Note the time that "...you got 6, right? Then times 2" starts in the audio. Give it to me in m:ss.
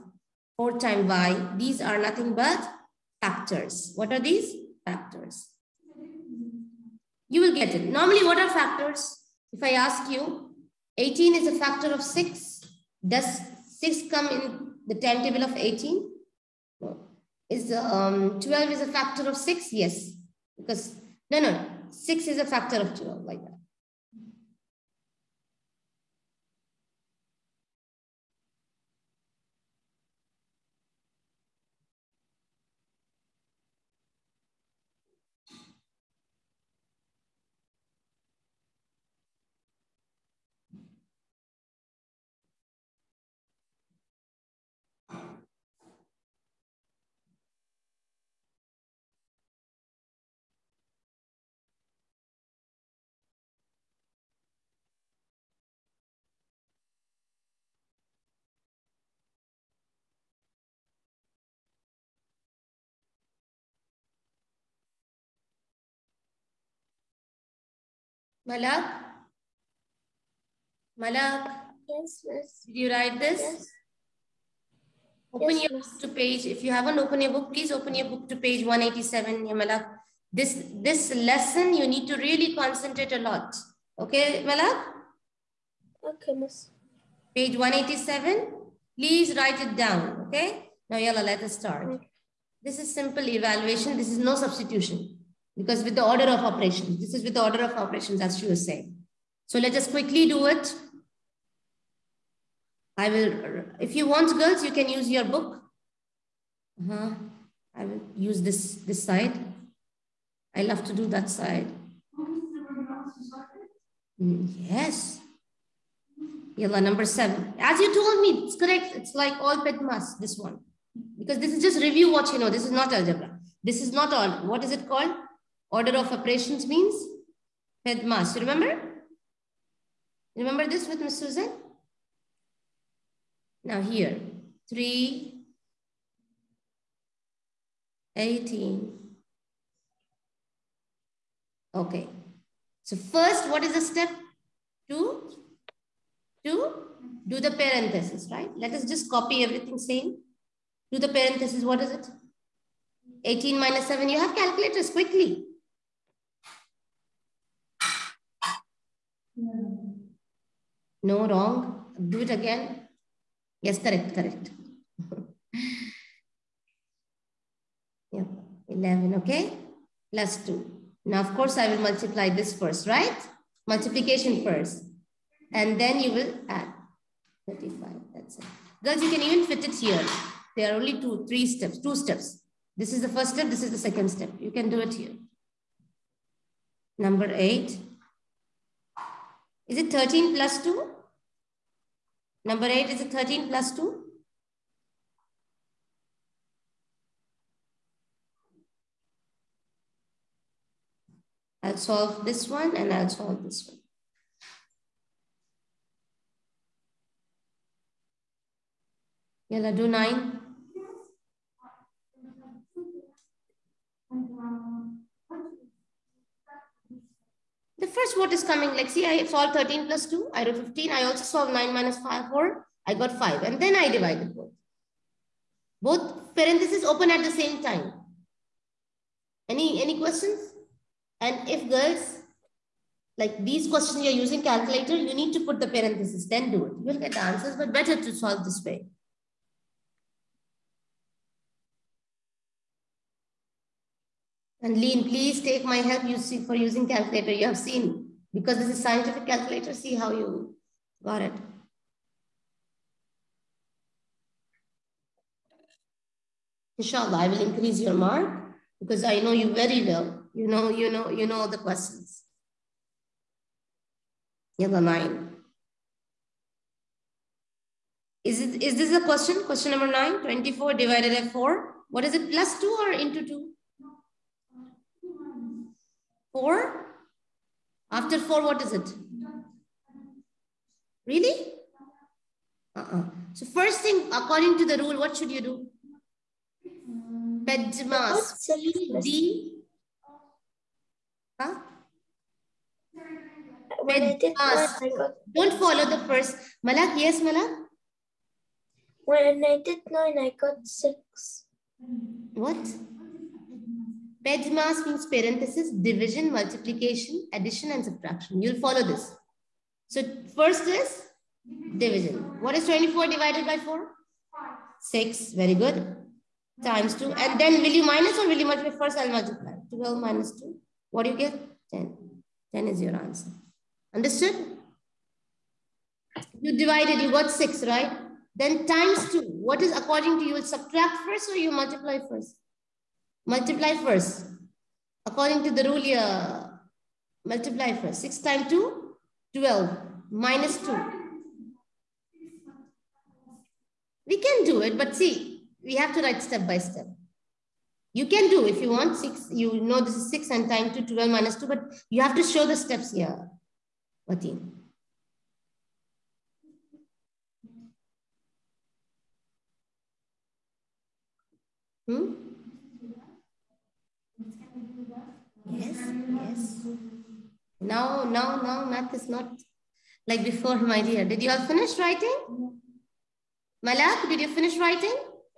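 5:27.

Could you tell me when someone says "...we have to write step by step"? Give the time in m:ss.
5:45.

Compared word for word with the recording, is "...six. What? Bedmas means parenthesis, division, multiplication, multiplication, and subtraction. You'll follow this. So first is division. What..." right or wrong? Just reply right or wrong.
wrong.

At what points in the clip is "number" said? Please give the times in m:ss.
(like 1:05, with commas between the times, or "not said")
1:56, 3:06, 3:12, 4:24, 4:29.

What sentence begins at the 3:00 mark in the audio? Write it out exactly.
There are only two, three steps, two steps.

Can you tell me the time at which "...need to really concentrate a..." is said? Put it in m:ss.
1:21.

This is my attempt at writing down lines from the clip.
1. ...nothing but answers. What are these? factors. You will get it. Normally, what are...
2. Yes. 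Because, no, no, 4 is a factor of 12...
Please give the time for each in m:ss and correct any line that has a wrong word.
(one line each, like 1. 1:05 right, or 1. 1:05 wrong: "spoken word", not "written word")
1. 0:01 wrong: "factors", not "answers"
2. 0:19 wrong: "6", not "4".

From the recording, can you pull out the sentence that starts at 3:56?
You'll get answers, but better to solve this way.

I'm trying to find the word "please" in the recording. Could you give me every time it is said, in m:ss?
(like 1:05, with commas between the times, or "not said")
1:17, 1:28, 4:05.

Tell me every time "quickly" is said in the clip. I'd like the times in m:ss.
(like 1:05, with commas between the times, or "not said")
1:39, 2:34.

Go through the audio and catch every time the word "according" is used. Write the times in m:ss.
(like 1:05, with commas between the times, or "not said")
4:44, 5:29, 5:35.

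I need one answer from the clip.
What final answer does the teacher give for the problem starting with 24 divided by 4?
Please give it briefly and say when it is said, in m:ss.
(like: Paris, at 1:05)
10, at 5:22.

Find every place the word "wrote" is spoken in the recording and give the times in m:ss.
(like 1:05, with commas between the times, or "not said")
3:40.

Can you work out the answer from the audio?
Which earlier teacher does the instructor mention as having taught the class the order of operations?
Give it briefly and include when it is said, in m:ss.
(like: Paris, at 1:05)
Miss Susan, at 2:10.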